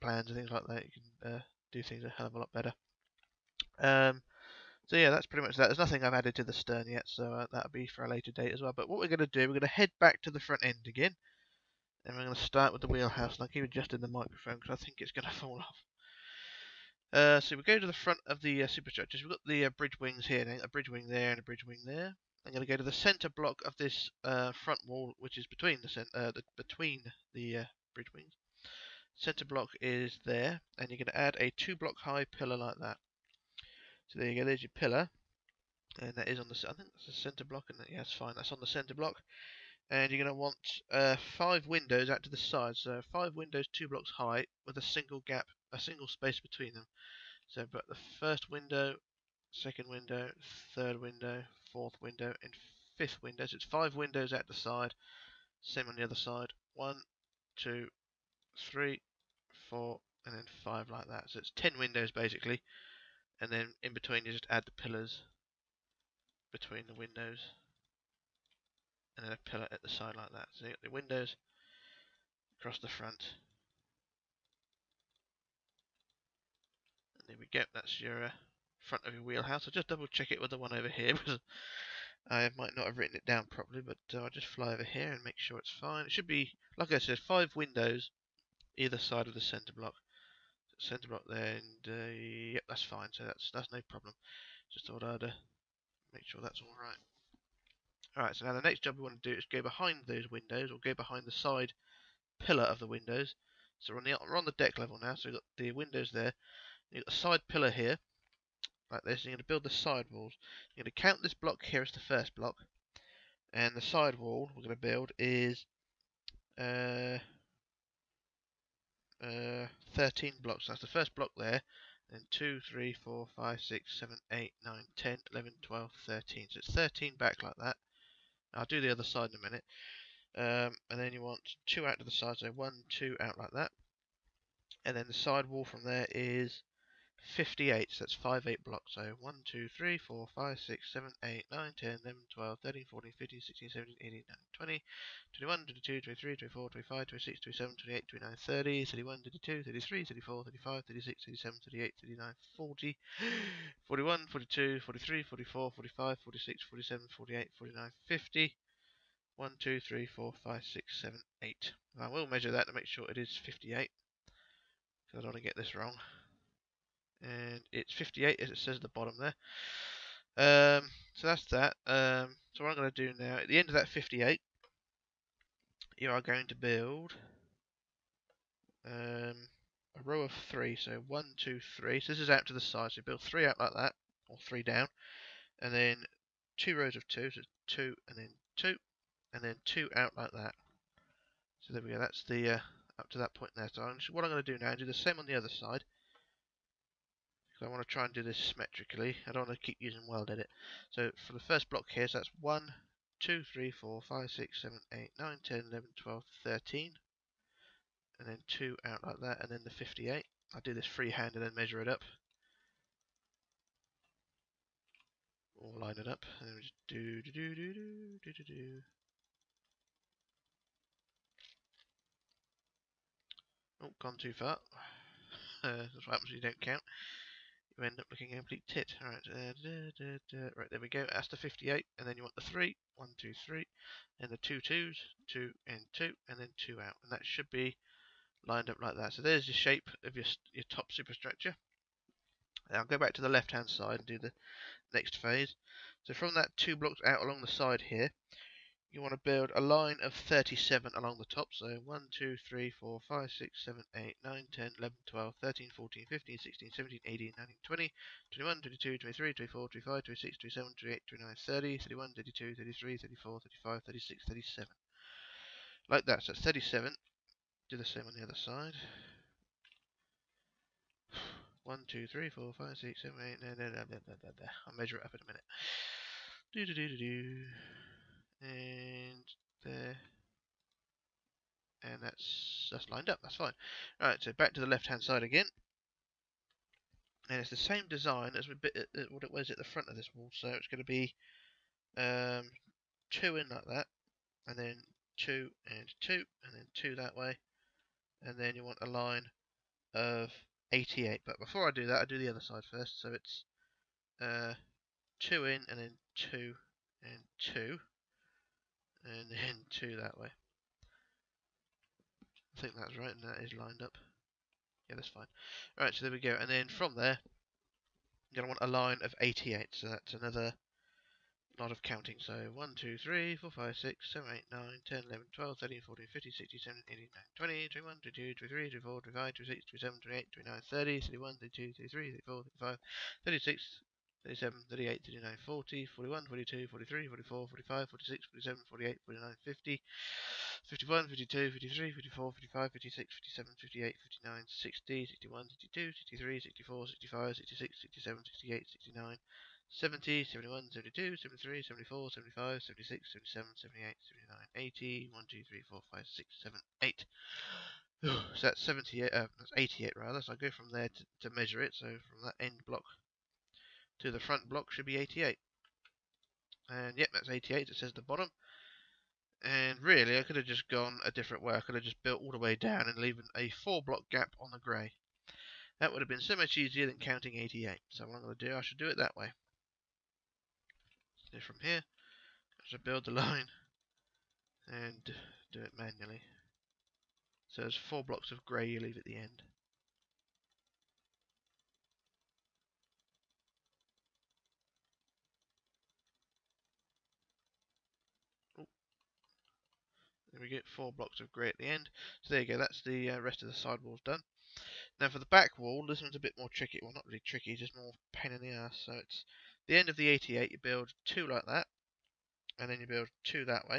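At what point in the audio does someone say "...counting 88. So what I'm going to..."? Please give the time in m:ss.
6:16.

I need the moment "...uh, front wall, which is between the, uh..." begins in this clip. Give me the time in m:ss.
0:24.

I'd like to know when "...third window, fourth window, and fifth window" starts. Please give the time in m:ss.
0:50.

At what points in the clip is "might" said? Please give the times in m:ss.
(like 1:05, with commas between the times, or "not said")
1:22.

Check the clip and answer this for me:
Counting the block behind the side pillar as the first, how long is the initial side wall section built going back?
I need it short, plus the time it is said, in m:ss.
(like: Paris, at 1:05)
13, at 1:59.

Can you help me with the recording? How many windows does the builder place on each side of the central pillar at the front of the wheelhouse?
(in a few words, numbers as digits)
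5.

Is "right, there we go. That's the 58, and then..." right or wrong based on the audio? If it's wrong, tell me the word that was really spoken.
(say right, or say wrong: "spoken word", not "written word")
right.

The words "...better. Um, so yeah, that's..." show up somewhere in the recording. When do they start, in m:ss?
0:02.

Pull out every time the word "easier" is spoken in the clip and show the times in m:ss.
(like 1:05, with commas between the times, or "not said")
6:16.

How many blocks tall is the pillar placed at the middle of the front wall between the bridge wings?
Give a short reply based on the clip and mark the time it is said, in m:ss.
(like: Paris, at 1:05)
2, at 0:31.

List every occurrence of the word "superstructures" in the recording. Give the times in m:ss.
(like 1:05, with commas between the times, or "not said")
0:18, 4:00.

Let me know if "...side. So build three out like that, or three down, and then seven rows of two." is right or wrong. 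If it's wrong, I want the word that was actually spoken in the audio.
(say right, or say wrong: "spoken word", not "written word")
wrong: "two", not "seven".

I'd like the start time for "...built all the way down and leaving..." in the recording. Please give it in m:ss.
6:12.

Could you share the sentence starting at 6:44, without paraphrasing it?
Now for the back wall, this one's a bit more tricky.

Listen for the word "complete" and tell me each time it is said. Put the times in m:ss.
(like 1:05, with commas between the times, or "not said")
3:48.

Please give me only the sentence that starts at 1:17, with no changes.
And there we go, that's your uh, front of your wheelhouse.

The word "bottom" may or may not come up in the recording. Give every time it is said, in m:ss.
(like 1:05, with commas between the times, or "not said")
2:48, 6:08.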